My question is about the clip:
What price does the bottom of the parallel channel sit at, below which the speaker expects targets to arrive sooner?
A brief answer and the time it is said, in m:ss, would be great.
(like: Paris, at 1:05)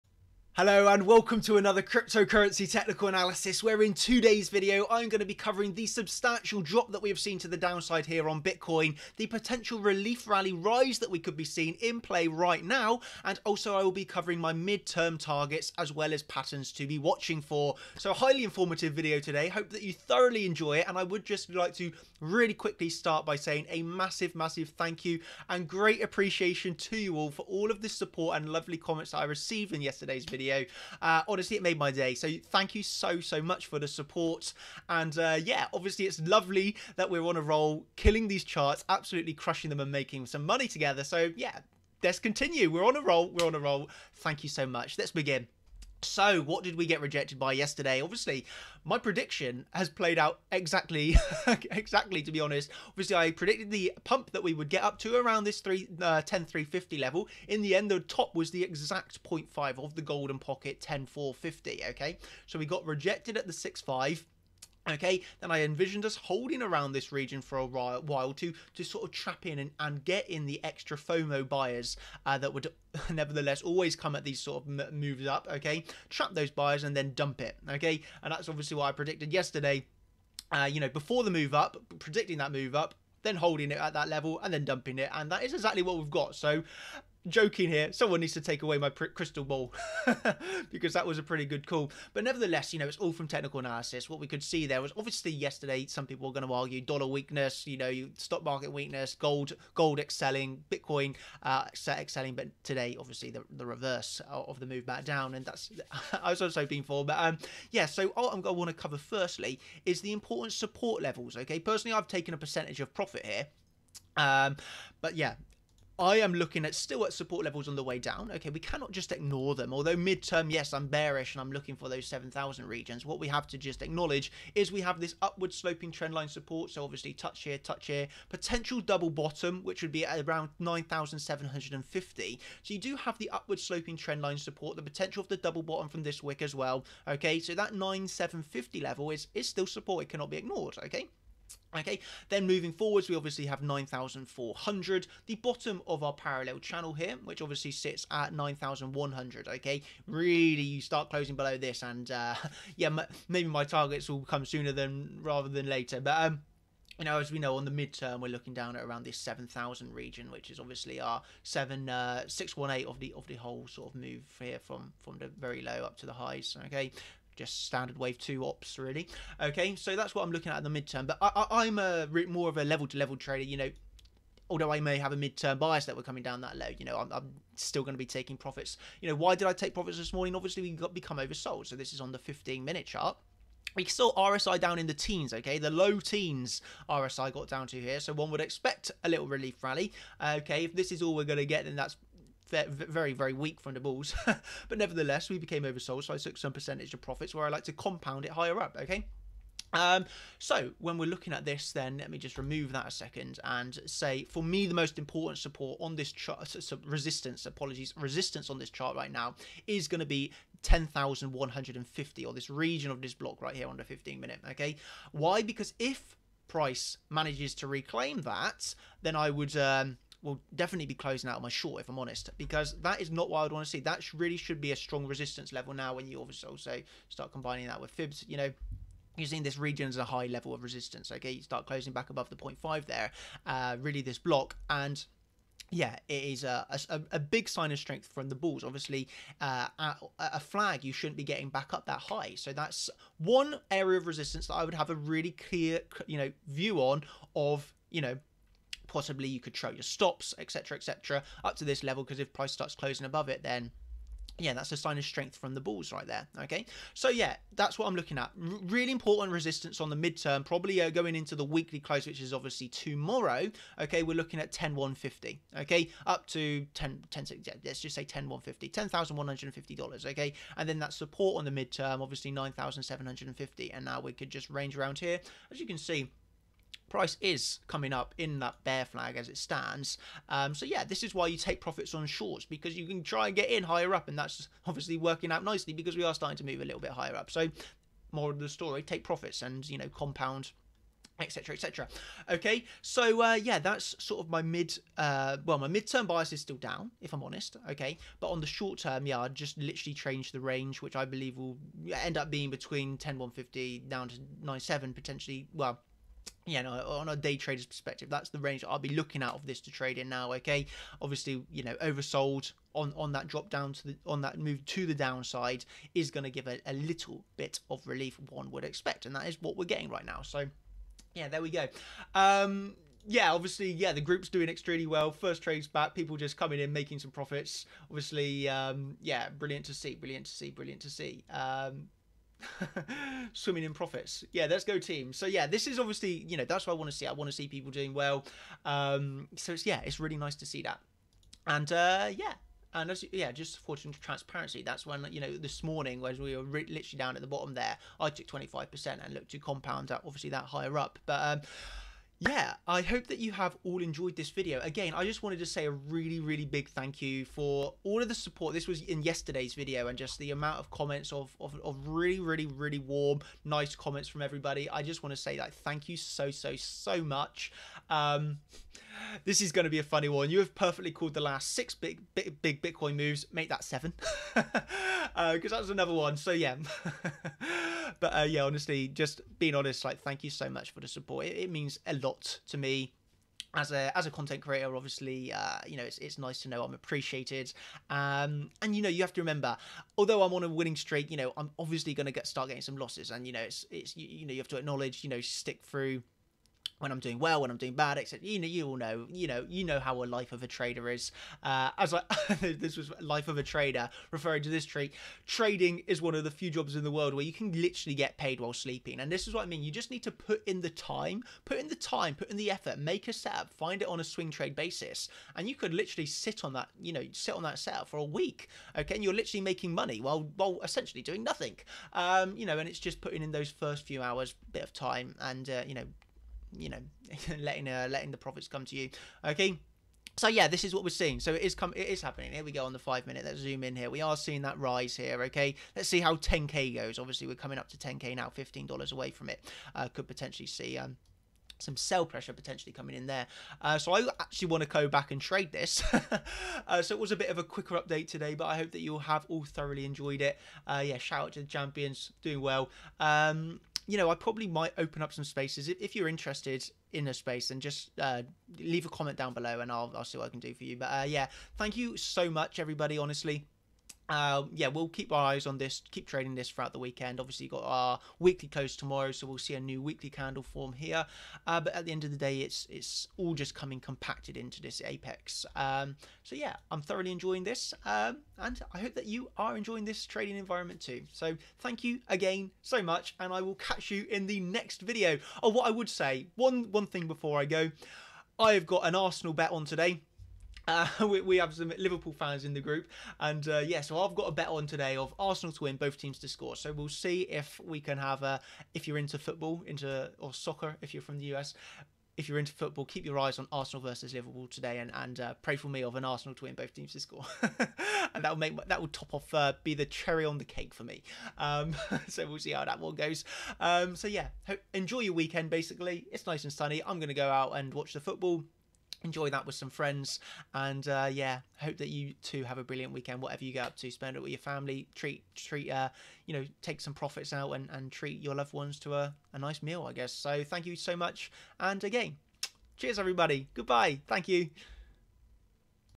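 9,100, at 2:28.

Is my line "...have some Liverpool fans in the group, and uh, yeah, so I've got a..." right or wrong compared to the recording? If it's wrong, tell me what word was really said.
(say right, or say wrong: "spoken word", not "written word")
right.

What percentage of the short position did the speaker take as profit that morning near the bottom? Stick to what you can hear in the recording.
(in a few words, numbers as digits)
25%.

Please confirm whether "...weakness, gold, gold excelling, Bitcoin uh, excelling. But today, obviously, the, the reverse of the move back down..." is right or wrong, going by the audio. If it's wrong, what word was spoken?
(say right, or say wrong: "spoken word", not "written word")
right.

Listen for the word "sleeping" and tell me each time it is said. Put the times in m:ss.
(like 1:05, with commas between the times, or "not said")
6:48.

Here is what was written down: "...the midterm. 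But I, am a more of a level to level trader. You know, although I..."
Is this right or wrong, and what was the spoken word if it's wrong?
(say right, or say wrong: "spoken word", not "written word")
right.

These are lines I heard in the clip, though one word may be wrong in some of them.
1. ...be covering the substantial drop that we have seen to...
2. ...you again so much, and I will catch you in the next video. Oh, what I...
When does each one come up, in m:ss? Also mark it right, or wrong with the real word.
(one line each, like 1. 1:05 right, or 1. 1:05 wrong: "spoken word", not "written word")
1. 0:05 right
2. 8:01 right.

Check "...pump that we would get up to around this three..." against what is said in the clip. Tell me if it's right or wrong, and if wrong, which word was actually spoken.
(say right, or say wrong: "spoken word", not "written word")
right.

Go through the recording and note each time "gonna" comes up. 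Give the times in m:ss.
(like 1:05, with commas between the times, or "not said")
8:36.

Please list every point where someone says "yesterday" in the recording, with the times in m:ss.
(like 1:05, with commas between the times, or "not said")
0:29, 0:47, 1:19, 1:35, 5:59.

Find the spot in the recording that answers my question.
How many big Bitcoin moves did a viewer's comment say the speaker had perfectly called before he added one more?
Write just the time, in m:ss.
6:11.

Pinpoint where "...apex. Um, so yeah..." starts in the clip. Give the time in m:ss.
7:54.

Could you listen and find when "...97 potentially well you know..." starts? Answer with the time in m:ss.
5:04.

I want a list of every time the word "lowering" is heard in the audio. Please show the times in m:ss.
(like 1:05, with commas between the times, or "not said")
not said.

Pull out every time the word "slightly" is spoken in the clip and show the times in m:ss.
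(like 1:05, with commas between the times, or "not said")
not said.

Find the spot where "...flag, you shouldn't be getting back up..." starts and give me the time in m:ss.
4:00.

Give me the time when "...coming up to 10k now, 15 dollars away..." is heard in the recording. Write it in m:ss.
7:17.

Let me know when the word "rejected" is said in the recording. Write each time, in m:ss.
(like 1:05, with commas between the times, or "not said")
0:47, 1:02.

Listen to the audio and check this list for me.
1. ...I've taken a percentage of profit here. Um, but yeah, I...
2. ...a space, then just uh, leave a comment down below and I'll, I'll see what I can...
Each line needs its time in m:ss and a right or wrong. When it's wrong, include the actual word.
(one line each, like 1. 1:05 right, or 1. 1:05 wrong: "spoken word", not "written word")
1. 1:51 right
2. 7:37 right.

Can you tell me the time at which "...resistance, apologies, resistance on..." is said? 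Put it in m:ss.
3:26.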